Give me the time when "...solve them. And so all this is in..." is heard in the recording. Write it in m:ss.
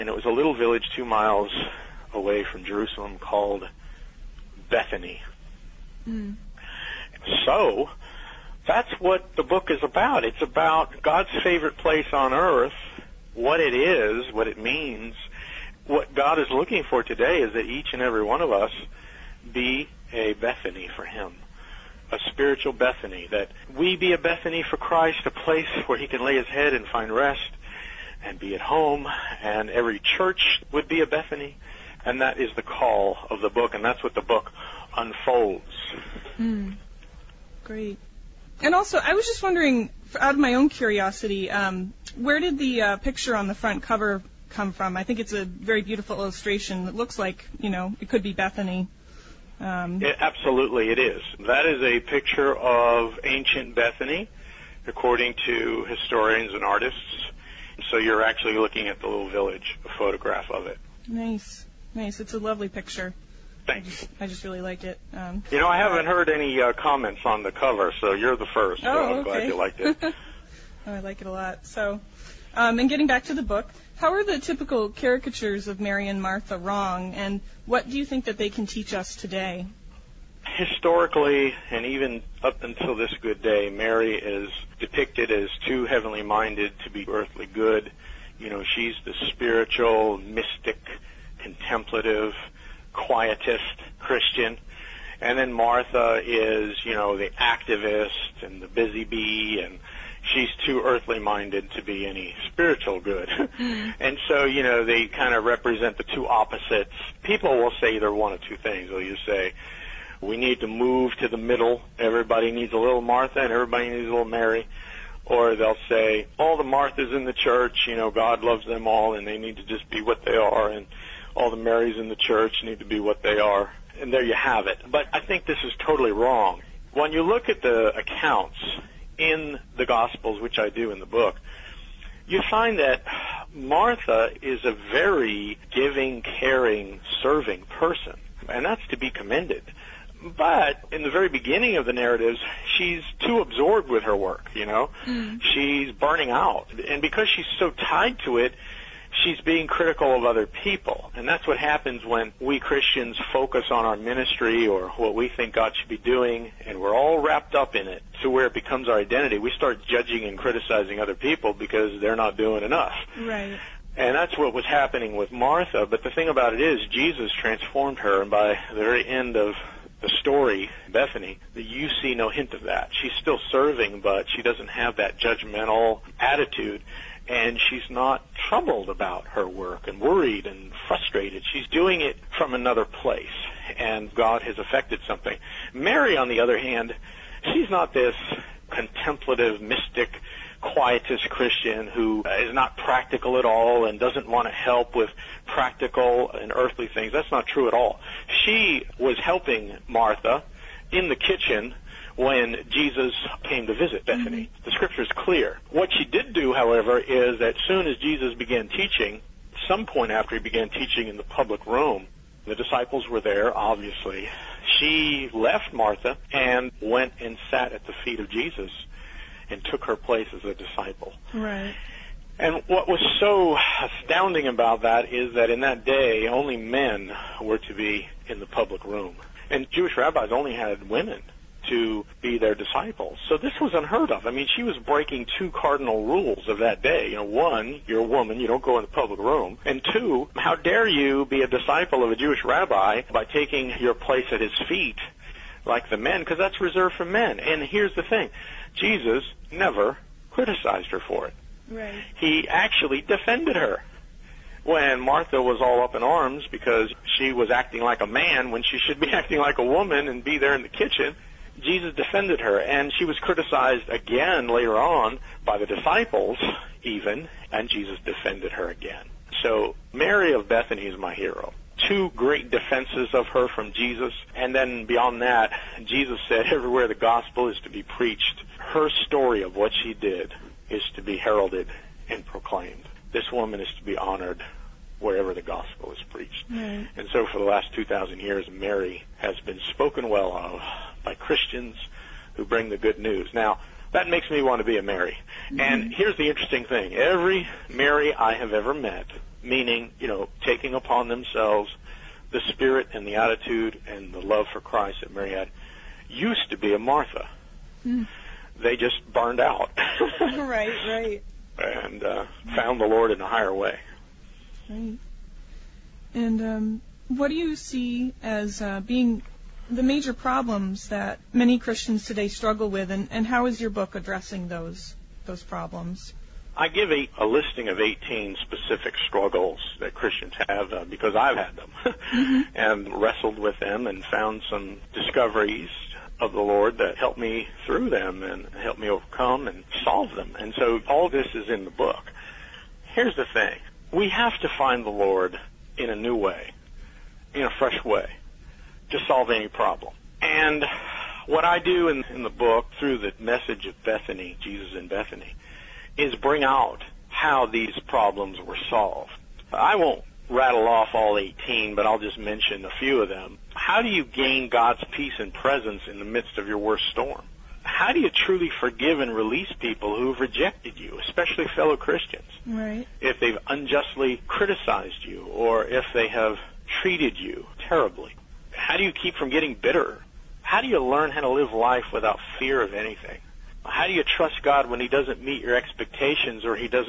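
5:39.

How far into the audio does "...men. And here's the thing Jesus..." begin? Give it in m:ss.
4:07.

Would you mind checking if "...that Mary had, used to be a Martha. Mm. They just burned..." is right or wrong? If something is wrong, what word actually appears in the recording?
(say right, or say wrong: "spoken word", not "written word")
right.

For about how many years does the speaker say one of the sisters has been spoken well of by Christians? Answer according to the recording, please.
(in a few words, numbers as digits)
2,000 years.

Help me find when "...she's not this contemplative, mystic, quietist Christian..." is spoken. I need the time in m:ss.
3:07.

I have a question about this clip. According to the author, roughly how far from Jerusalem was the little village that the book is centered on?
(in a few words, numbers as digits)
2 miles.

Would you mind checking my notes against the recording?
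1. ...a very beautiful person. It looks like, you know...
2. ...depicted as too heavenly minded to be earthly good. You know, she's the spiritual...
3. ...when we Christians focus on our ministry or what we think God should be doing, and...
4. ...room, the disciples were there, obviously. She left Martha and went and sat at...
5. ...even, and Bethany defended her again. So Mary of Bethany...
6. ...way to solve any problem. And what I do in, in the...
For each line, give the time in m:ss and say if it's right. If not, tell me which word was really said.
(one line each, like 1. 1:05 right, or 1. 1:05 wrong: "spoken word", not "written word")
1. 0:45 wrong: "illustration", not "person"
2. 1:24 right
3. 2:32 right
4. 3:31 right
5. 4:26 wrong: "Jesus", not "Bethany"
6. 5:47 right.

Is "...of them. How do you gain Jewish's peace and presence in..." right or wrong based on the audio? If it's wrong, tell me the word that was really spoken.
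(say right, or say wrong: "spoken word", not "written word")
wrong: "God", not "Jewish".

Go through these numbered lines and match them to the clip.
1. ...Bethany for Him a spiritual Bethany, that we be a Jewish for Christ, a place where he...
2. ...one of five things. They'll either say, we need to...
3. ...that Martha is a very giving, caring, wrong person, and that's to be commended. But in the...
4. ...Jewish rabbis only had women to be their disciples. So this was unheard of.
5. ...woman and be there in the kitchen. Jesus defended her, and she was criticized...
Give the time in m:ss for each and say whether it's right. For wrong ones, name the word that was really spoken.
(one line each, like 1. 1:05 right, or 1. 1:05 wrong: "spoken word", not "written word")
1. 0:20 wrong: "Bethany", not "Jewish"
2. 1:48 wrong: "two", not "five"
3. 2:12 wrong: "serving", not "wrong"
4. 3:49 right
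5. 4:19 right.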